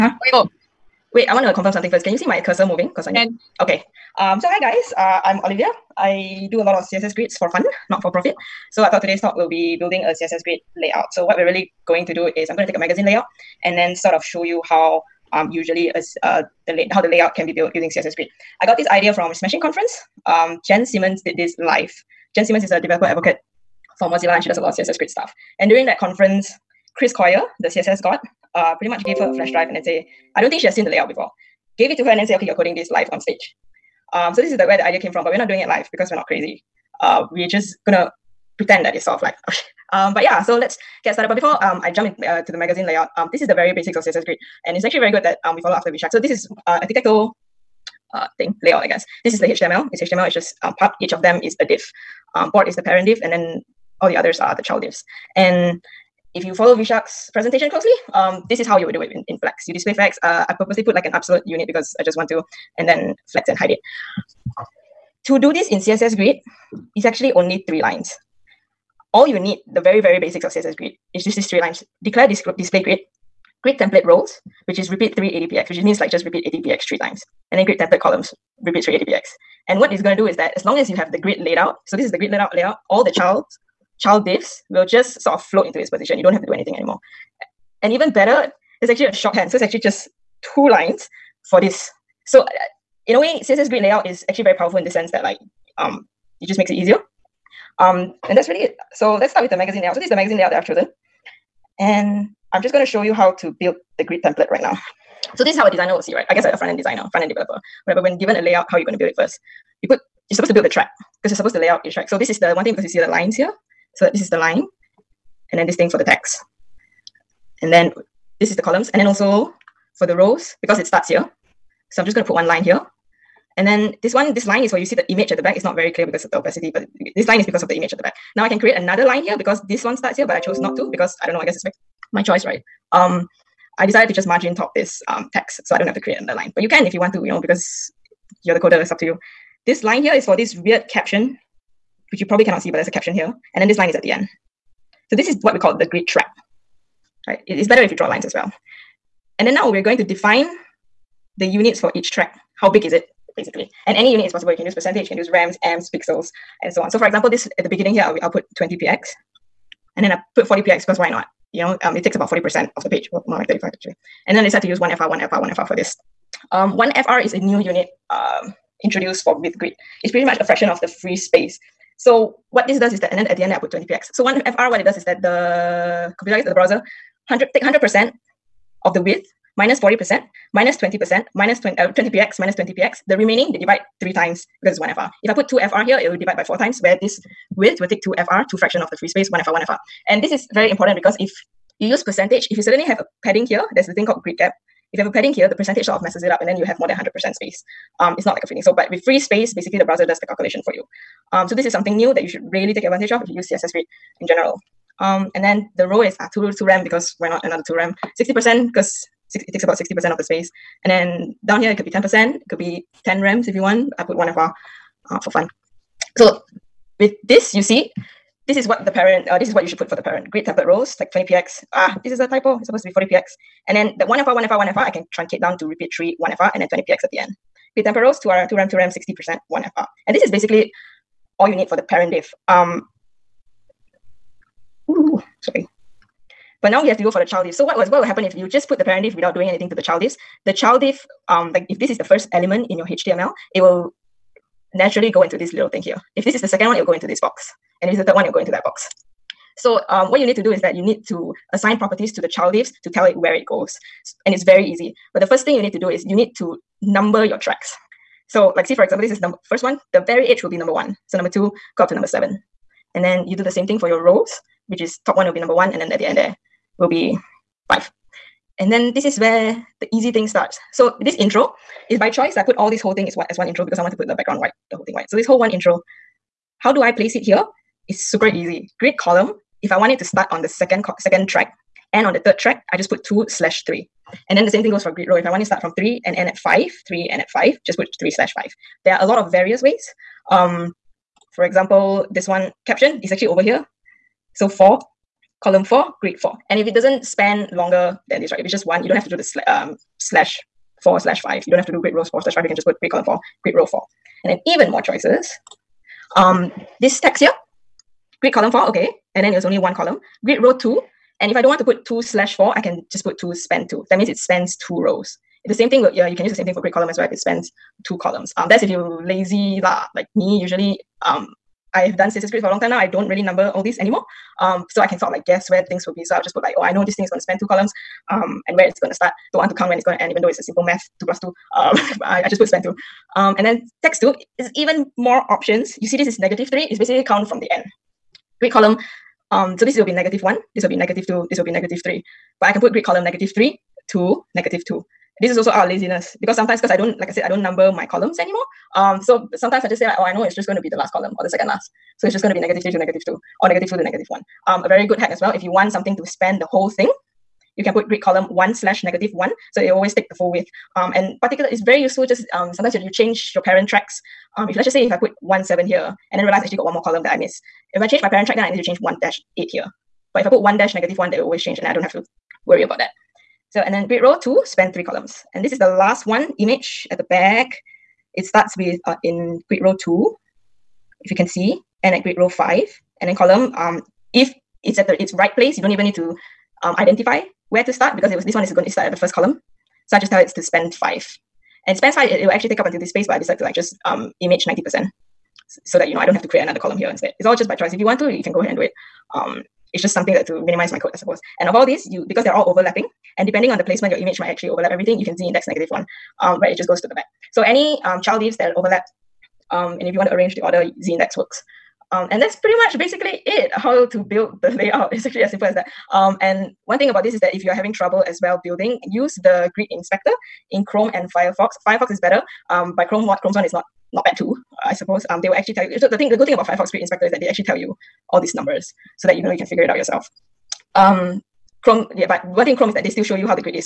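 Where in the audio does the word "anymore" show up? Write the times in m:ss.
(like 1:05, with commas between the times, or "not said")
1:26, 5:23, 5:48.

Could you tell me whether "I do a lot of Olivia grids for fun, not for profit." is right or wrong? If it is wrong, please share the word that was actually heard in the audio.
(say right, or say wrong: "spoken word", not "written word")
wrong: "CSS", not "Olivia".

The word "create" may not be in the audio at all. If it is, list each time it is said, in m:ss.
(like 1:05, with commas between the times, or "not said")
2:08, 2:15, 6:36.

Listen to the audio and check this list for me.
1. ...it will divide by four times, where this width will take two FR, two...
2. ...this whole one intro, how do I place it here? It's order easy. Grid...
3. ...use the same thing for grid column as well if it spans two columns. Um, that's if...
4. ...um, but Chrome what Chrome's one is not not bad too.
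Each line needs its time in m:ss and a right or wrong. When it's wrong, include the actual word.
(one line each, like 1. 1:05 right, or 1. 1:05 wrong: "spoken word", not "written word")
1. 3:05 right
2. 4:35 wrong: "super", not "order"
3. 5:16 right
4. 7:02 right.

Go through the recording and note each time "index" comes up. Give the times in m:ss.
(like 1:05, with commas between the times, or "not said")
6:45, 6:50.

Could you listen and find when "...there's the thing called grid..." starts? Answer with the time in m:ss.
3:13.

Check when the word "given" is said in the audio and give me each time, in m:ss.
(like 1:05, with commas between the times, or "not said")
1:48.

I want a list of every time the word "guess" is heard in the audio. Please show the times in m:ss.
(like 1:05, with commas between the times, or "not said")
0:48, 1:46, 2:11, 2:56, 5:25.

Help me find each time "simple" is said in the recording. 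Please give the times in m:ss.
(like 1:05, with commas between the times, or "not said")
5:30, 6:55.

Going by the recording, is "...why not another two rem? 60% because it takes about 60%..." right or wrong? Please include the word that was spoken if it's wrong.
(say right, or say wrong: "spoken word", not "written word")
right.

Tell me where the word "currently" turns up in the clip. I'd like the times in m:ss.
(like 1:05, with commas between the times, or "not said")
not said.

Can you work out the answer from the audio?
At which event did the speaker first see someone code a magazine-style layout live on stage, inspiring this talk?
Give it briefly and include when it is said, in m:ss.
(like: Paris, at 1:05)
Smashing Conference, at 0:19.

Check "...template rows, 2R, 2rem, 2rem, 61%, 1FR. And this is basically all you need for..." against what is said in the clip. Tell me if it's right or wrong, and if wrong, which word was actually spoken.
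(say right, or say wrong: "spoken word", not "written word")
wrong: "60", not "61".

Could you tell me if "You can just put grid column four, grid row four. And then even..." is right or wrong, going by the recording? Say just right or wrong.
right.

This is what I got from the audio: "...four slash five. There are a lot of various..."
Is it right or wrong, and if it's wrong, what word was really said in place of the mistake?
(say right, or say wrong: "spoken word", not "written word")
wrong: "three", not "four".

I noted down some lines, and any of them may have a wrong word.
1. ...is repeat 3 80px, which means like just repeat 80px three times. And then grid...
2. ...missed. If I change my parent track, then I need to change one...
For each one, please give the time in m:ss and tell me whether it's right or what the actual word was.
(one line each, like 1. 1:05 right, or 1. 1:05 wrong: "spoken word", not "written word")
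1. 1:14 right
2. 6:07 right.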